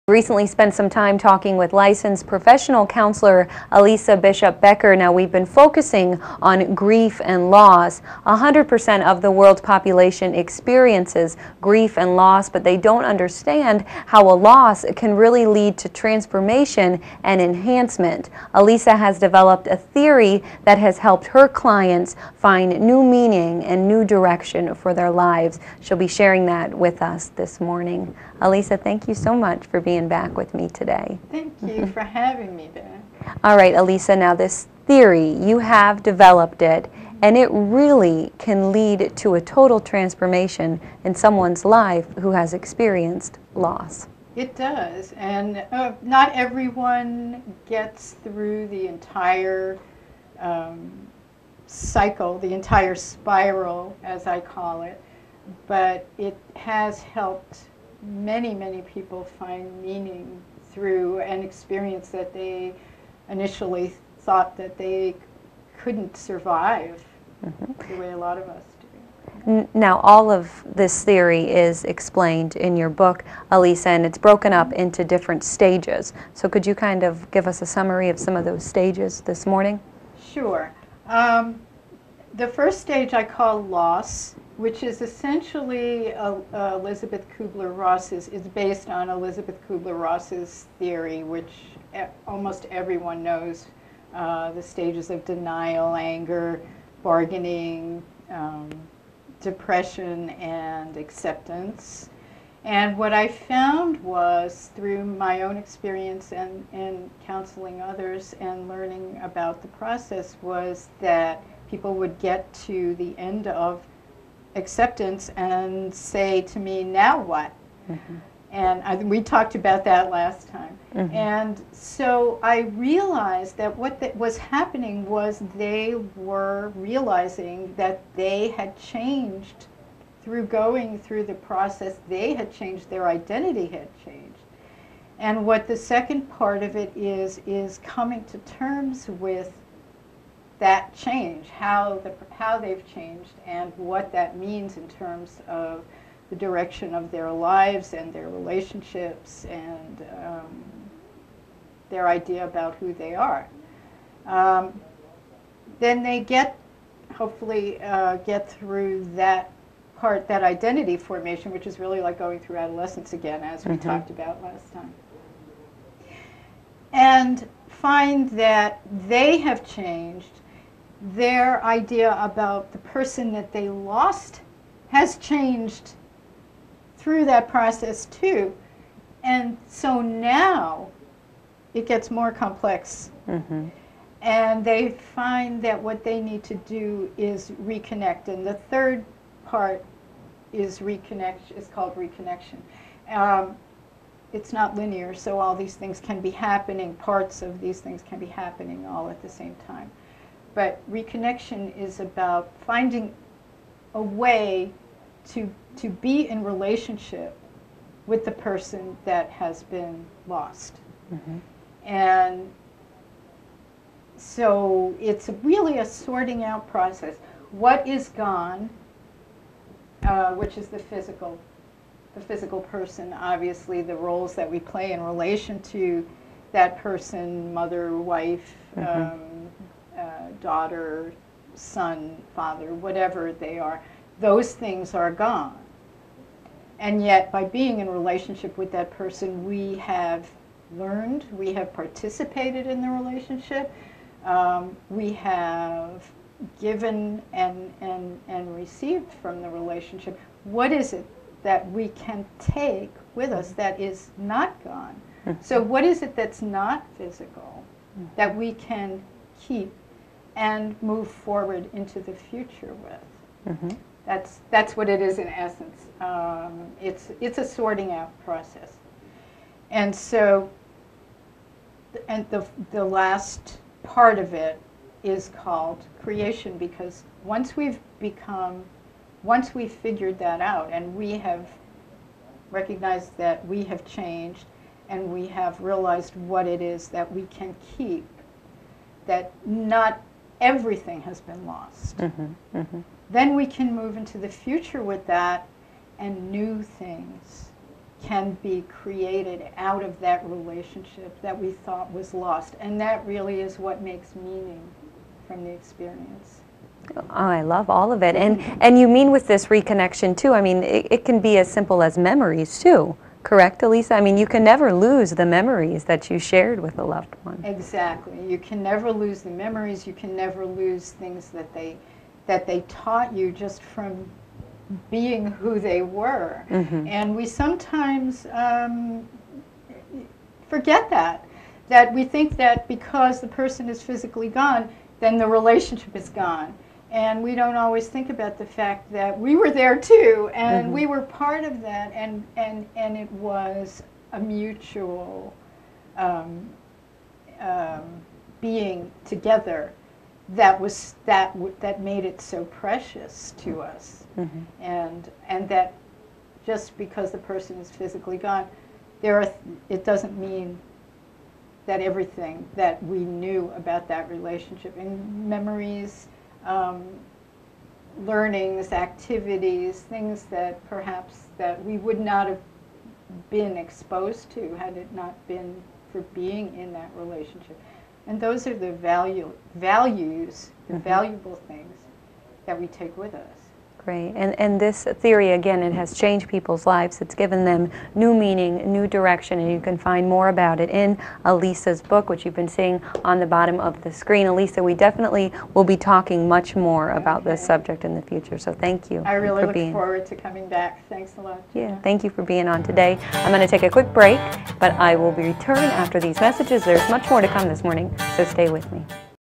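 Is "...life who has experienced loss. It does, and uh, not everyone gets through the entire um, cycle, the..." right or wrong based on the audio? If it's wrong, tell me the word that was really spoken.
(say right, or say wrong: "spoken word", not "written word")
right.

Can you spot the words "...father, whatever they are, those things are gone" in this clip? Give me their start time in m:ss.
3:52.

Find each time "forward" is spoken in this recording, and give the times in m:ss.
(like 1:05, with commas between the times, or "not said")
4:21, 6:39.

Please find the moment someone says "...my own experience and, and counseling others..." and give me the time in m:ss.
1:45.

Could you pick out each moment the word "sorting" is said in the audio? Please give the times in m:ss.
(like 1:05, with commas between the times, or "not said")
3:35, 4:27.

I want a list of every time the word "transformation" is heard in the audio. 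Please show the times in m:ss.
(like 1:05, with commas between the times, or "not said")
0:15, 0:39.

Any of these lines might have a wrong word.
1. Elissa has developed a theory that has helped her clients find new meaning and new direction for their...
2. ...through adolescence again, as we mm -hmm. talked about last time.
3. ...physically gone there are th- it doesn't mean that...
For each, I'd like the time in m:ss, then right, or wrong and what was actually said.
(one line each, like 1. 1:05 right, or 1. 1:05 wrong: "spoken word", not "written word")
1. 0:18 right
2. 2:42 right
3. 5:57 right.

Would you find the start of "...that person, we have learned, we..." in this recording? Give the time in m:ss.
3:58.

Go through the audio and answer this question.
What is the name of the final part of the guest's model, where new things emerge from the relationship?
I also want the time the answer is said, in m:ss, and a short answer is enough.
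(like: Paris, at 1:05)
Creation, at 4:36.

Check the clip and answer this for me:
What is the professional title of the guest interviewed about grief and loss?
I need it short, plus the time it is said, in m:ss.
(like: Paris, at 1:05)
Licensed professional counselor, at 0:01.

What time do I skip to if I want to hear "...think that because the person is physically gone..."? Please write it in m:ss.
5:32.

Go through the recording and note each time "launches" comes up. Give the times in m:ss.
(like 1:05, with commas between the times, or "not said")
not said.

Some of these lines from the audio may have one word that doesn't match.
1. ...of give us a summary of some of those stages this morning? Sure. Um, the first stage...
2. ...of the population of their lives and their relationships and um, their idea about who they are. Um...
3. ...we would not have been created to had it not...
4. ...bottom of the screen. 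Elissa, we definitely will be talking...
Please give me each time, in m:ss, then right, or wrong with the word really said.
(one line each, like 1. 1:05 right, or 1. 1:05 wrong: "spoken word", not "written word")
1. 1:17 right
2. 2:25 wrong: "direction", not "population"
3. 6:11 wrong: "exposed", not "created"
4. 6:33 right.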